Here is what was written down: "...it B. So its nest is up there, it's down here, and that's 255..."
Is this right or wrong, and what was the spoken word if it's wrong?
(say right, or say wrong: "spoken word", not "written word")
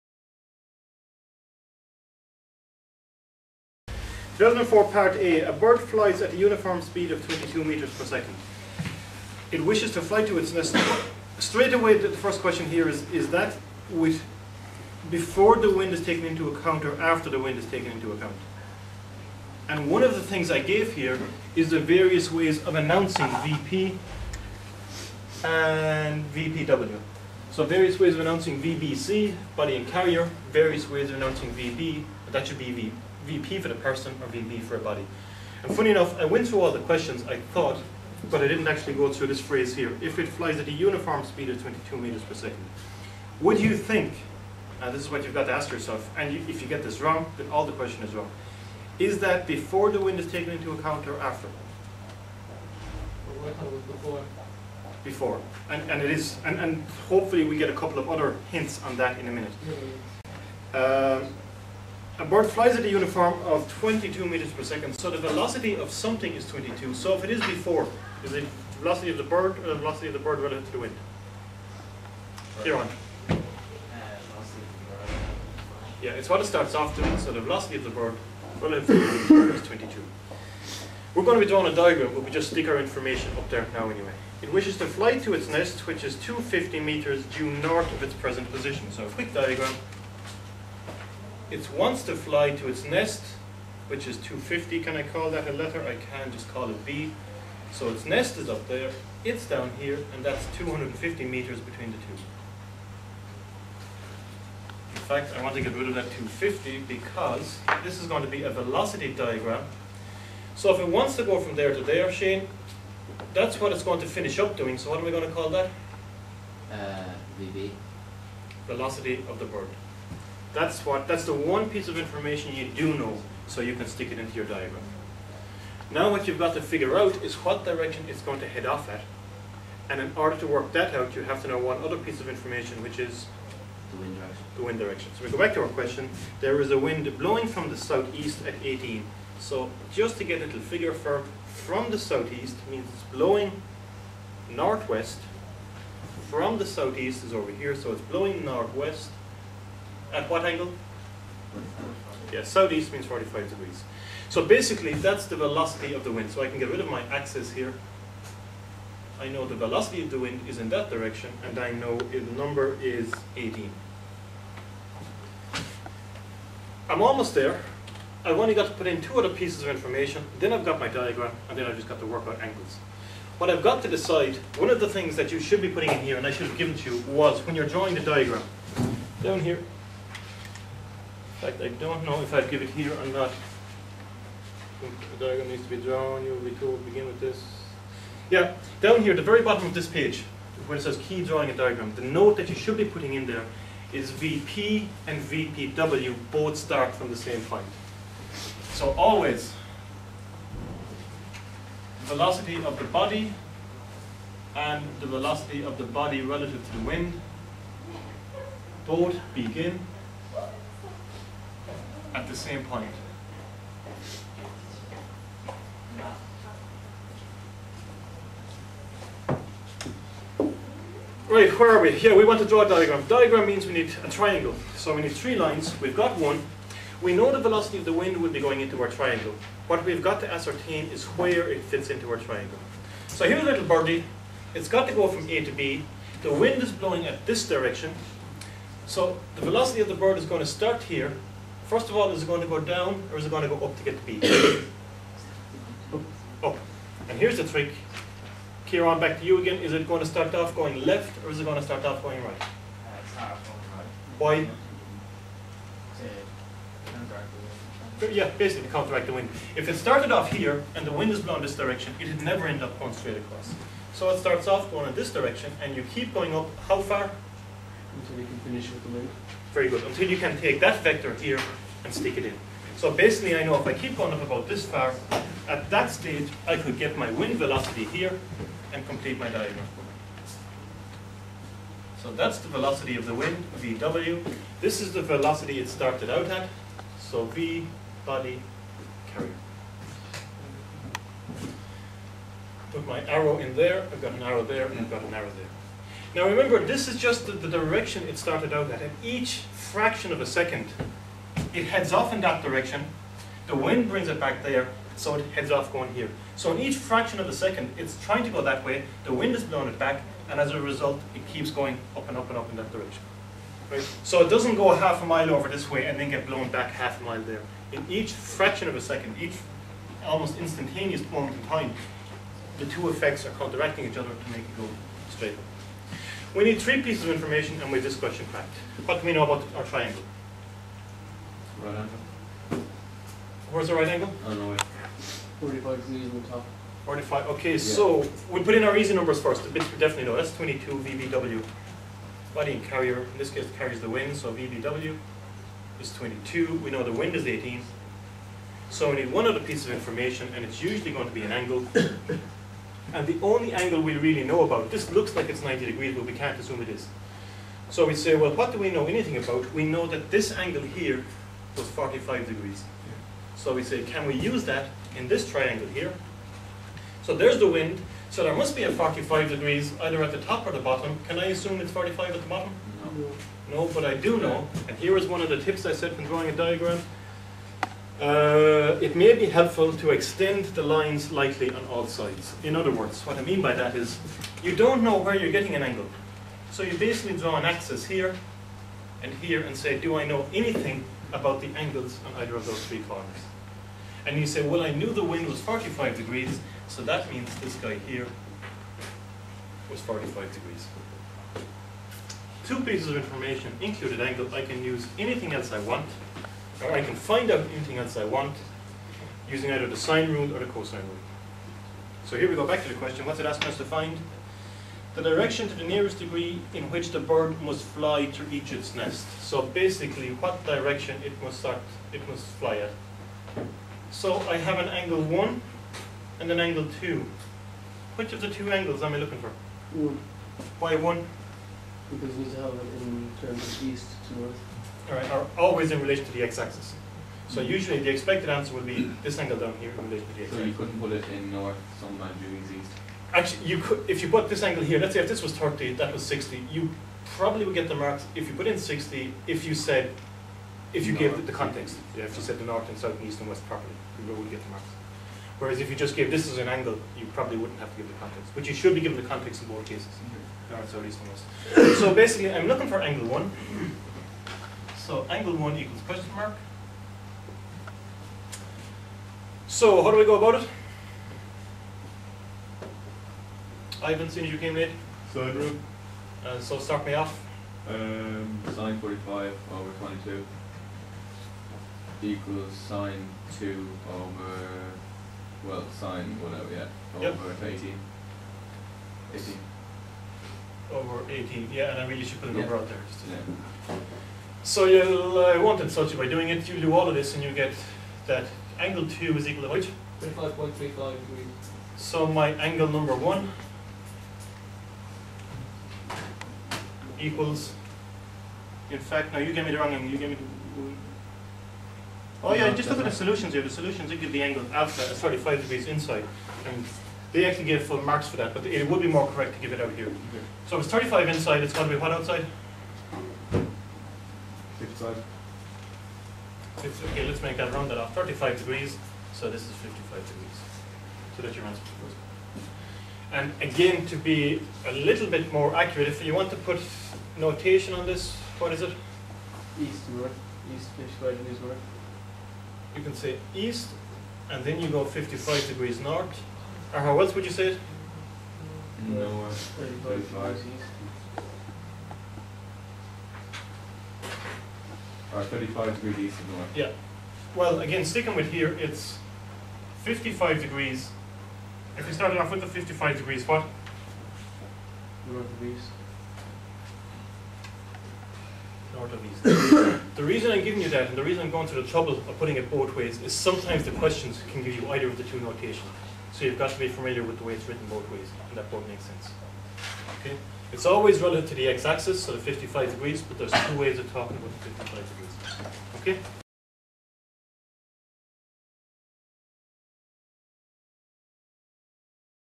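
wrong: "250", not "255".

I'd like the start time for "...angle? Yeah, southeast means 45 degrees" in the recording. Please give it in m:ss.
2:30.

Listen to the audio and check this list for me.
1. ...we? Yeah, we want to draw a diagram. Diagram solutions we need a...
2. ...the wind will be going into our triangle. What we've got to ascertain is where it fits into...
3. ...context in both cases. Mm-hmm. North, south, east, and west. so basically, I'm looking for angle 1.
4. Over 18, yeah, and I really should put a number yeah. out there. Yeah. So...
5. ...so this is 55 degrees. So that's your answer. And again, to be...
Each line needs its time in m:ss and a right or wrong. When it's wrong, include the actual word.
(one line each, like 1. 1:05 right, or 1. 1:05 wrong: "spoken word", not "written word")
1. 3:41 wrong: "means", not "solutions"
2. 3:47 right
3. 7:39 right
4. 8:10 right
5. 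8:49 right.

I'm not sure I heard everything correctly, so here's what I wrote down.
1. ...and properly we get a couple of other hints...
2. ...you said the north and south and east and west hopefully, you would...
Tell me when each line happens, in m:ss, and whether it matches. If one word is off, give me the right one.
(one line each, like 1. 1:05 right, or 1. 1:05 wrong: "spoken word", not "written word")
1. 0:56 wrong: "hopefully", not "properly"
2. 7:32 wrong: "properly", not "hopefully".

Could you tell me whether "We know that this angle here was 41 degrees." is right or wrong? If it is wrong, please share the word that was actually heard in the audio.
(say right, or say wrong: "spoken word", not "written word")
wrong: "45", not "41".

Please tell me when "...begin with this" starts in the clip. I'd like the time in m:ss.
3:06.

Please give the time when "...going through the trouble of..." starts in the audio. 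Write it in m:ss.
9:31.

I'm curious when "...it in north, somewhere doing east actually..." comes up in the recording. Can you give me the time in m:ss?
7:20.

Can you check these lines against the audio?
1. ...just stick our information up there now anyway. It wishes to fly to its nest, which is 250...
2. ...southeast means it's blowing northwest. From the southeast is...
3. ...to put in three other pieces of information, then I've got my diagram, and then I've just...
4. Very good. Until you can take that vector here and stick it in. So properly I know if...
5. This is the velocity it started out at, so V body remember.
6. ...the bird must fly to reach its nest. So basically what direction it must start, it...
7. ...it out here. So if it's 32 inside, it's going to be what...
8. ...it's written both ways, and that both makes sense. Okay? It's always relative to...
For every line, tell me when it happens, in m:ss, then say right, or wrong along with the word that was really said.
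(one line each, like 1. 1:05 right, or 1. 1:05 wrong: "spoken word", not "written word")
1. 1:22 right
2. 2:21 right
3. 2:48 wrong: "two", not "three"
4. 4:29 wrong: "basically", not "properly"
5. 4:44 wrong: "carrier", not "remember"
6. 6:56 right
7. 8:39 wrong: "35", not "32"
8. 9:37 right.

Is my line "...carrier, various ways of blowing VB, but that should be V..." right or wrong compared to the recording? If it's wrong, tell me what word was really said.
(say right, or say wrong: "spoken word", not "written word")
wrong: "announcing", not "blowing".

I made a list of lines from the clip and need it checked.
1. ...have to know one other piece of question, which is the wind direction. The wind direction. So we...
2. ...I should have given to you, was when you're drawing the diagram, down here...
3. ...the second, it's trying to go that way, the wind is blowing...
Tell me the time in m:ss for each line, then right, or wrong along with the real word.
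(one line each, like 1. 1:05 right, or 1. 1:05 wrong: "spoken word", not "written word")
1. 2:11 wrong: "information", not "question"
2. 2:56 right
3. 5:07 right.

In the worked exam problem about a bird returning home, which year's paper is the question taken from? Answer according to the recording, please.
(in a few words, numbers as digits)
2004.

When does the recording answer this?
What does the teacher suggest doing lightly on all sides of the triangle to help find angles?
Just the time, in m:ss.
6:19.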